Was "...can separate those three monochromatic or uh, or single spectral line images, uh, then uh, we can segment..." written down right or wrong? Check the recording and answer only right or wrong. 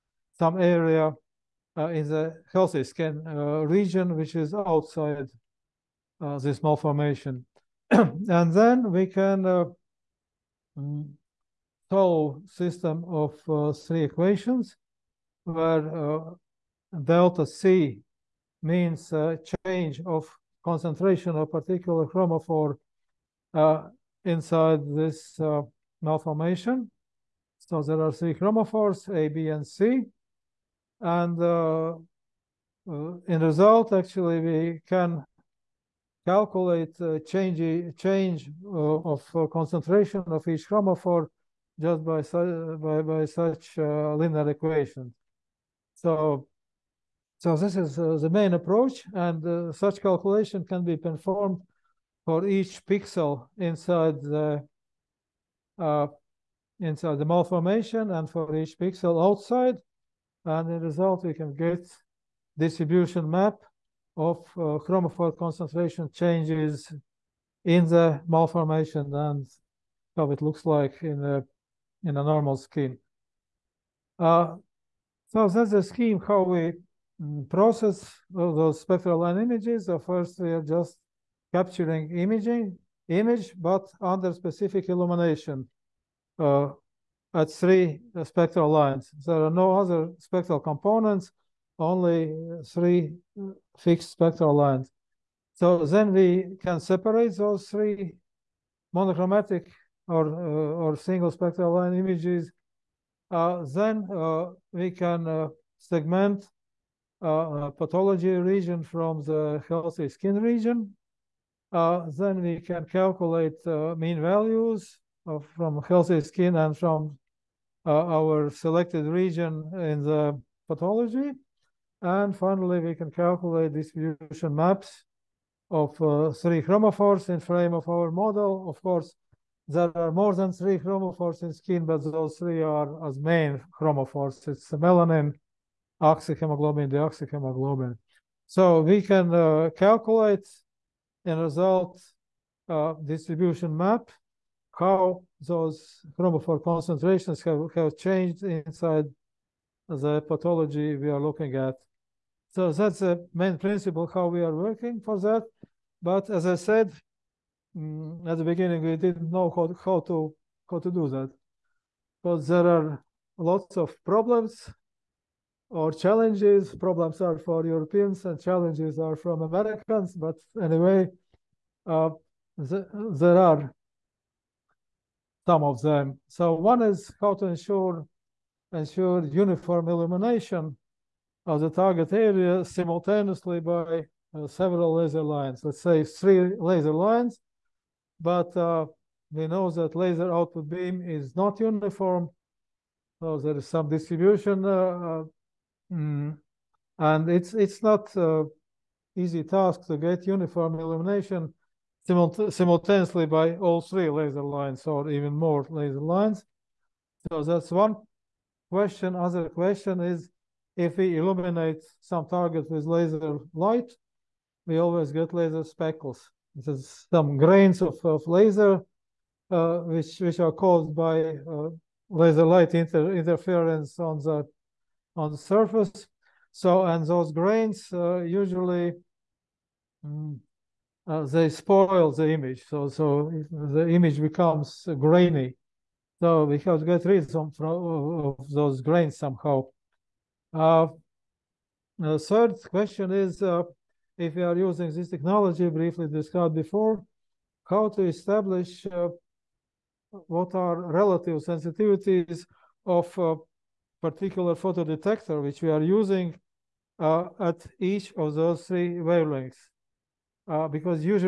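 right.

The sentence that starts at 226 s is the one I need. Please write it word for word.
So and those grains uh, usually mm, uh, they spoil the image.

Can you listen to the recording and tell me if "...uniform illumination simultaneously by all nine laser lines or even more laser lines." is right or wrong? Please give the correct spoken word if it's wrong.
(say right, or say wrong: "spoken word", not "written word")
wrong: "three", not "nine".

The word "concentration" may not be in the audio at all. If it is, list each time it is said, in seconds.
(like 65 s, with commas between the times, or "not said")
20 s, 39 s, 65 s, 146 s.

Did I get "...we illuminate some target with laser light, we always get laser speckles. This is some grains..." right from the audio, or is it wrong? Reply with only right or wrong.
right.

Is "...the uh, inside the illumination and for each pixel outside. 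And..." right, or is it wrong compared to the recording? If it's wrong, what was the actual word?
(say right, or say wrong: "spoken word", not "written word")
wrong: "malformation", not "illumination".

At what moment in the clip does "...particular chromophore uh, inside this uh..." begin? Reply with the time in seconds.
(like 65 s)
21 s.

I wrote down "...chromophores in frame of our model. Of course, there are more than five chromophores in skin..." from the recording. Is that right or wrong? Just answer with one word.
wrong.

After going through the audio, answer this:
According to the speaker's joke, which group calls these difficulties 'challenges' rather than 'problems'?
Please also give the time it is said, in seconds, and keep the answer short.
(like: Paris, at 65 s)
Americans, at 169 s.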